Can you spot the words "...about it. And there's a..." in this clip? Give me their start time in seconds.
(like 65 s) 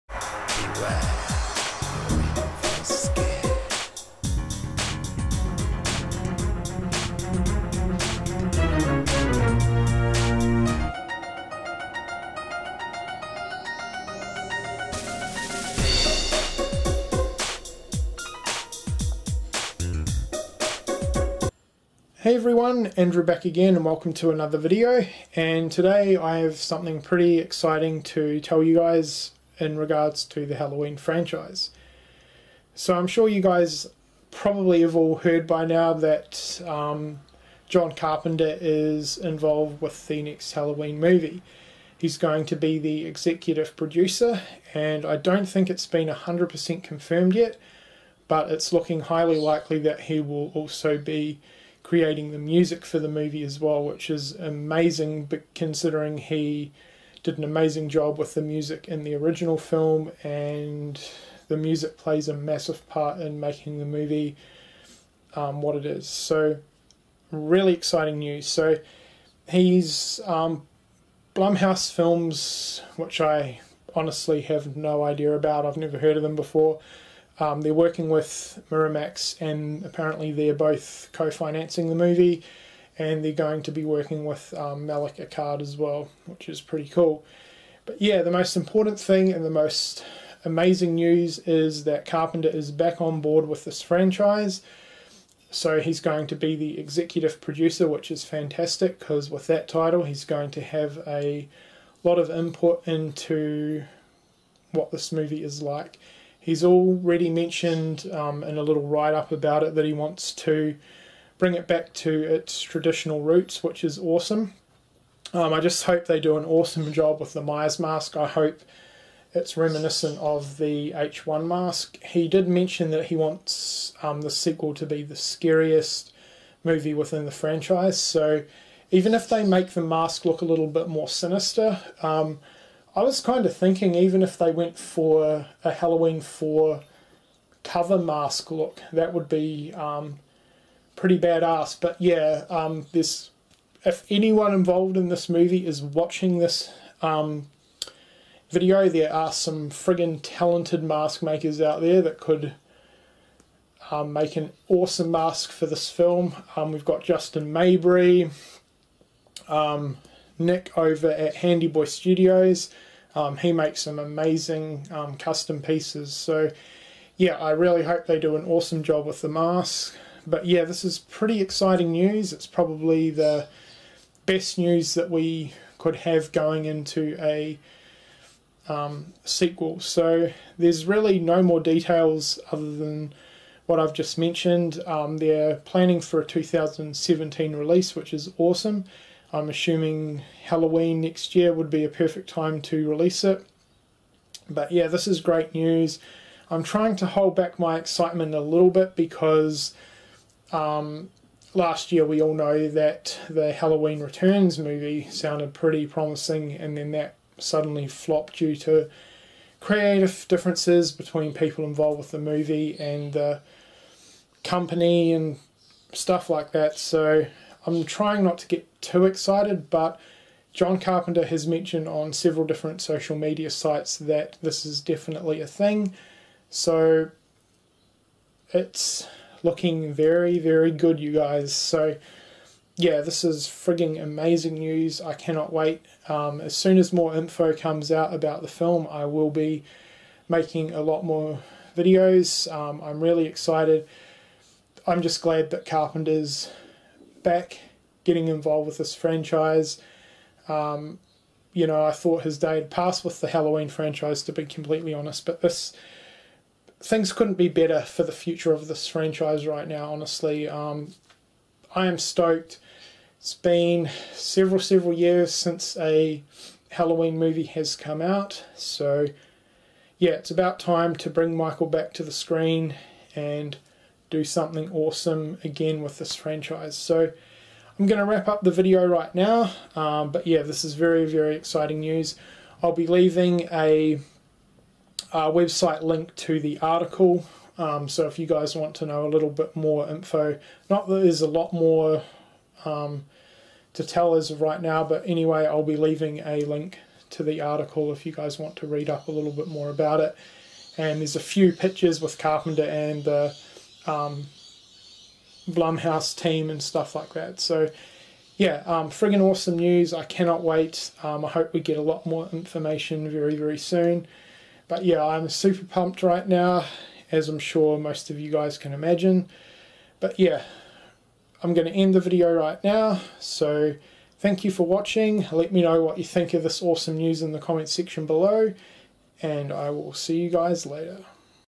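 299 s.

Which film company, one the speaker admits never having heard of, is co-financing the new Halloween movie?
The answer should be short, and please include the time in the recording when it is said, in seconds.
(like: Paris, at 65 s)
Blumhouse Films, at 71 s.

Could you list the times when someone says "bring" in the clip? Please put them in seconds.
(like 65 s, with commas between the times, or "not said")
111 s, 271 s.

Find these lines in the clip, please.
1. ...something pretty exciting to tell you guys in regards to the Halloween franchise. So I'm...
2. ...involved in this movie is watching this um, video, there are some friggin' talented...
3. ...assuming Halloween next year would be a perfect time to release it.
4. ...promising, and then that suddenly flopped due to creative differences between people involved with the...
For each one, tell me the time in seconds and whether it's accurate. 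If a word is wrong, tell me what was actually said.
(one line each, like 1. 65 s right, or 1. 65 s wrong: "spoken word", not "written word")
1. 26 s right
2. 144 s right
3. 189 s right
4. 205 s right.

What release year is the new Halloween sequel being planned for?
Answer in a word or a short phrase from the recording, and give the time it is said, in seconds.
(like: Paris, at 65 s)
2017, at 186 s.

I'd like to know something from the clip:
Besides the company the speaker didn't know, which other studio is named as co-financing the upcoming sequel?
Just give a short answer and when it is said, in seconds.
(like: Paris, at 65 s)
Miramax, at 78 s.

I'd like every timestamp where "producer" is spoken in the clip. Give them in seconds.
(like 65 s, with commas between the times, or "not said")
43 s, 97 s.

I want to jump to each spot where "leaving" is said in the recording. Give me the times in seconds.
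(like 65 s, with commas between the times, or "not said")
282 s, 295 s.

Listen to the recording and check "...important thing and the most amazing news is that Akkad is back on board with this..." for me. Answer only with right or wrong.
wrong.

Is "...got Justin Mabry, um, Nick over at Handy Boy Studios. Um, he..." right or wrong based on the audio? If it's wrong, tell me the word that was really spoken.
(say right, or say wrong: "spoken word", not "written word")
right.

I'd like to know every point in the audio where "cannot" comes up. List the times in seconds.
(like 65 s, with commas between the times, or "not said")
235 s, 310 s.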